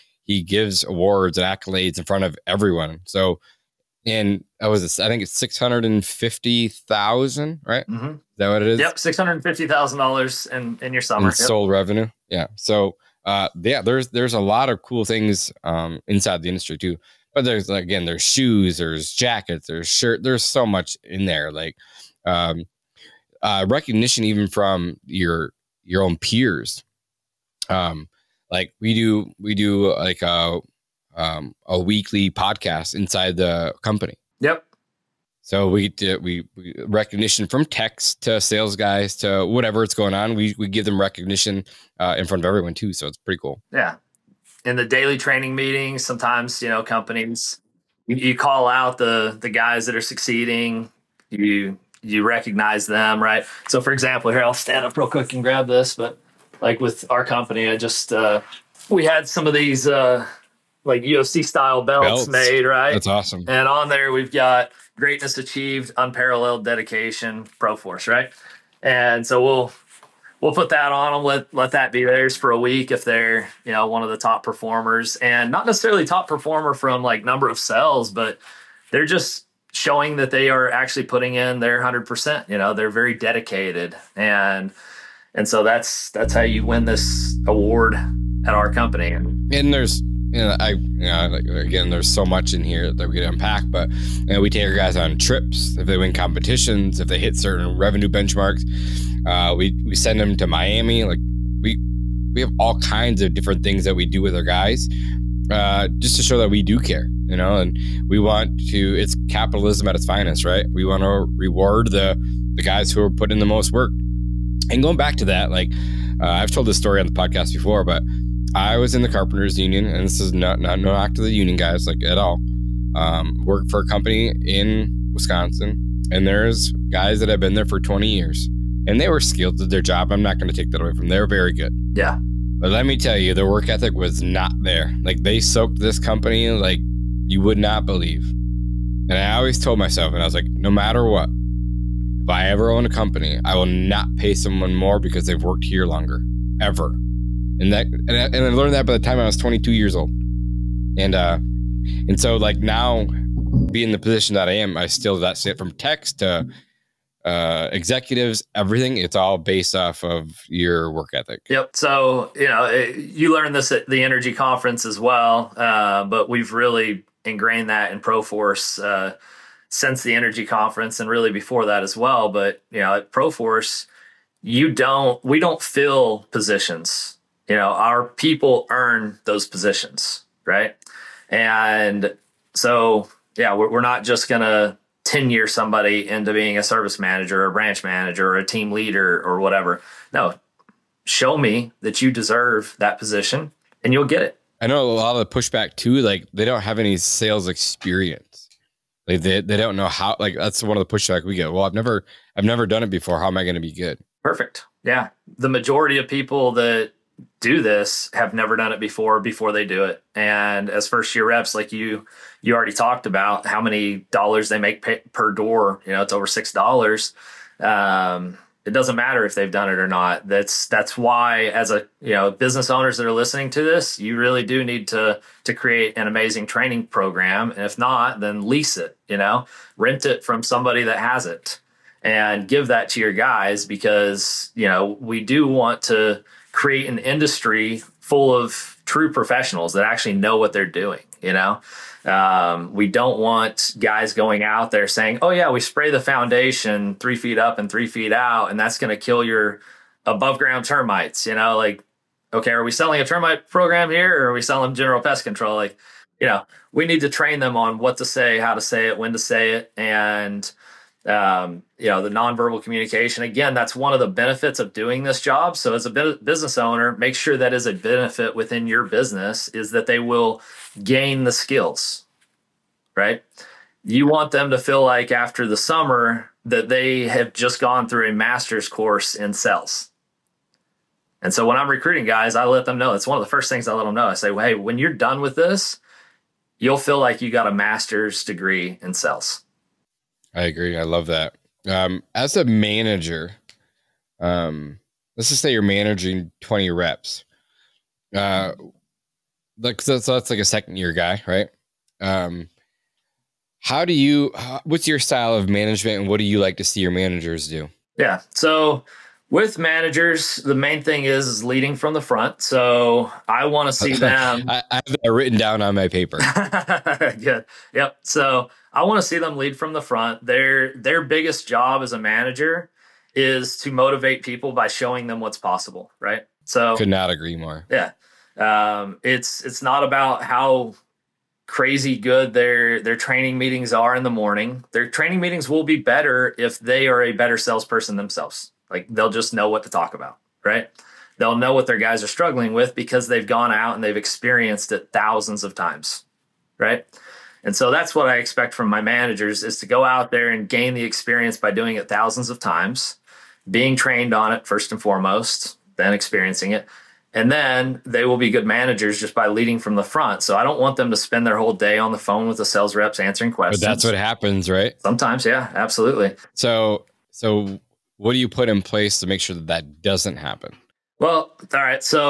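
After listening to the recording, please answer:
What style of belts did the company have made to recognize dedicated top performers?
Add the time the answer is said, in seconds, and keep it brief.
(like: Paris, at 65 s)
UFC style, at 61 s.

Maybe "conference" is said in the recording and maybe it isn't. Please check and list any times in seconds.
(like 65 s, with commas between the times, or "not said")
164 s, 170 s.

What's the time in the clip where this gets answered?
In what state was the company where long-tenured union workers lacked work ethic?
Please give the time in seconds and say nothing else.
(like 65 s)
125 s.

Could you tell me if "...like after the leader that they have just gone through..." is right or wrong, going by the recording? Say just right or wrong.
wrong.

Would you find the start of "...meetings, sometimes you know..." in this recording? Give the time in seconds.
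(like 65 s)
45 s.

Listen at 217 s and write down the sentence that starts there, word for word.
Um it doesn't matter if they've done it or not.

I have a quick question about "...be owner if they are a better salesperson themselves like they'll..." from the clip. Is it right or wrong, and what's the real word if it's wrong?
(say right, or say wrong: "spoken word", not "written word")
wrong: "better", not "owner".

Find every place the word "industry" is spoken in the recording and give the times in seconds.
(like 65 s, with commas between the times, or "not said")
16 s, 236 s.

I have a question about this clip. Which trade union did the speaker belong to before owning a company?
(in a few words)
carpenters union.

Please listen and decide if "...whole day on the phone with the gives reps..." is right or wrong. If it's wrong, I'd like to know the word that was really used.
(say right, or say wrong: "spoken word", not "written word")
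wrong: "sales", not "gives".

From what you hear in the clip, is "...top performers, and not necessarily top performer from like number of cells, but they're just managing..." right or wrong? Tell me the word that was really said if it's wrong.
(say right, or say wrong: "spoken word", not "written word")
wrong: "showing", not "managing".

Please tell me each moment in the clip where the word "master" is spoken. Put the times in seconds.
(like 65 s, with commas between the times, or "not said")
278 s, 287 s.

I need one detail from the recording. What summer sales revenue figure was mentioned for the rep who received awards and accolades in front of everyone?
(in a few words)
$650,000.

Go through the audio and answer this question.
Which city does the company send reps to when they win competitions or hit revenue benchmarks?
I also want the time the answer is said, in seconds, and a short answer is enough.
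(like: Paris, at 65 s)
Miami, at 100 s.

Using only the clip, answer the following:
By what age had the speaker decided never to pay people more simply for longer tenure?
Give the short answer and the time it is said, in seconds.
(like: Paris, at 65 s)
22, at 149 s.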